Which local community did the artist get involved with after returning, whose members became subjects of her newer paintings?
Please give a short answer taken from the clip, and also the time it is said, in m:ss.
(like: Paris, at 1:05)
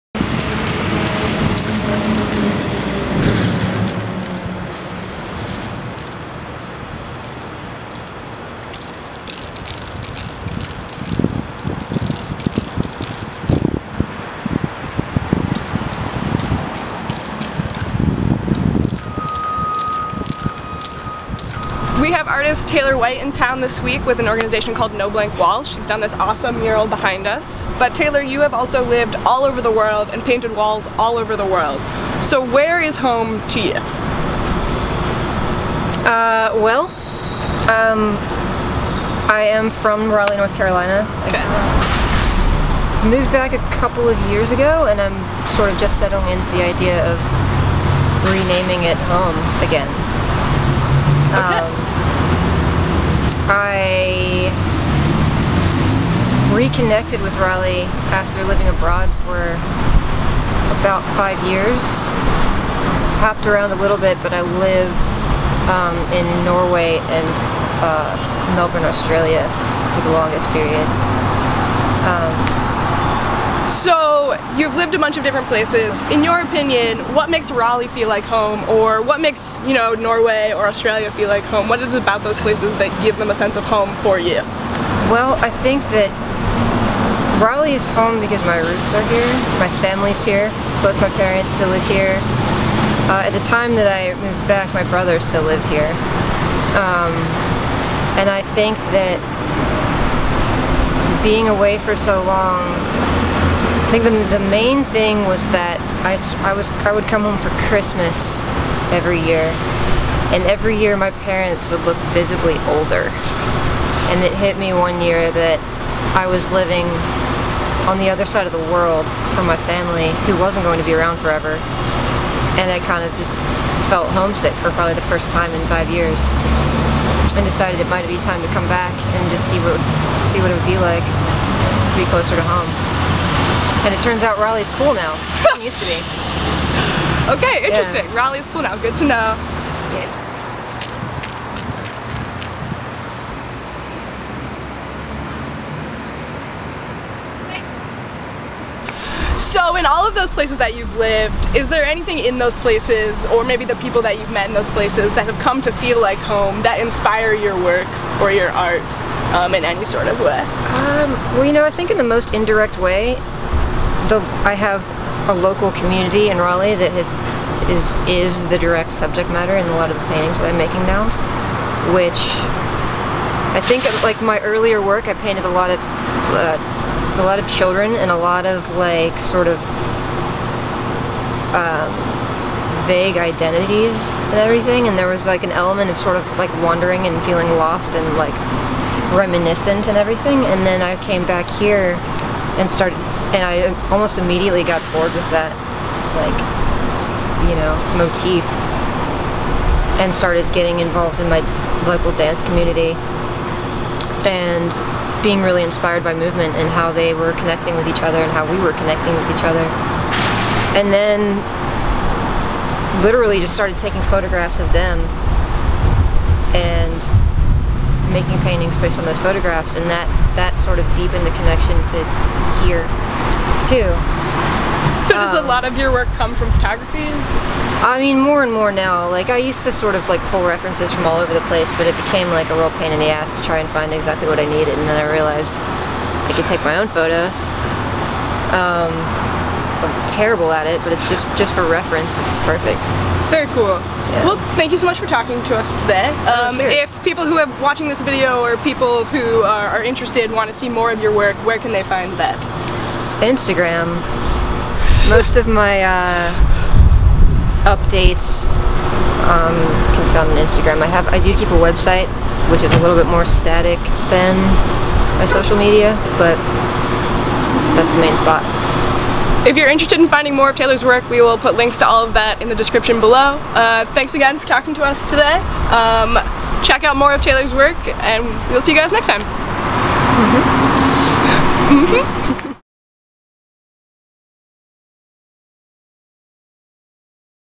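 dance community, at 3:22.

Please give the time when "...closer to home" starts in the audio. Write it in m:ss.
2:12.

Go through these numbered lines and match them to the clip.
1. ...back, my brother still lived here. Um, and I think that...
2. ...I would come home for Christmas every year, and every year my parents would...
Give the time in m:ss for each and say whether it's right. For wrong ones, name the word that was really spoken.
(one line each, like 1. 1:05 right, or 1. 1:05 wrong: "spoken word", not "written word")
1. 1:34 right
2. 1:46 right.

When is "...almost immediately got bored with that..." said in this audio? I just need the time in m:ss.
3:13.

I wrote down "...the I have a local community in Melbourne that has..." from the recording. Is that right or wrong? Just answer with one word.
wrong.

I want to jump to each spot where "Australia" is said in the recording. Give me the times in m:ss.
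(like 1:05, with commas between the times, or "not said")
1:08, 1:20.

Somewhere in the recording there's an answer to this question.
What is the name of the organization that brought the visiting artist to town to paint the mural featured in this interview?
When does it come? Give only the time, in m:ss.
0:24.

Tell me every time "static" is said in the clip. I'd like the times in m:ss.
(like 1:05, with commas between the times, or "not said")
4:23.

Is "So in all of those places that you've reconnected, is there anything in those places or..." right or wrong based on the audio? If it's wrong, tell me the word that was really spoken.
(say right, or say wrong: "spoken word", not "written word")
wrong: "lived", not "reconnected".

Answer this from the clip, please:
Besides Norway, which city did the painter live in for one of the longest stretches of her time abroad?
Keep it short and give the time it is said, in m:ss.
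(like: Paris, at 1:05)
Melbourne, at 1:08.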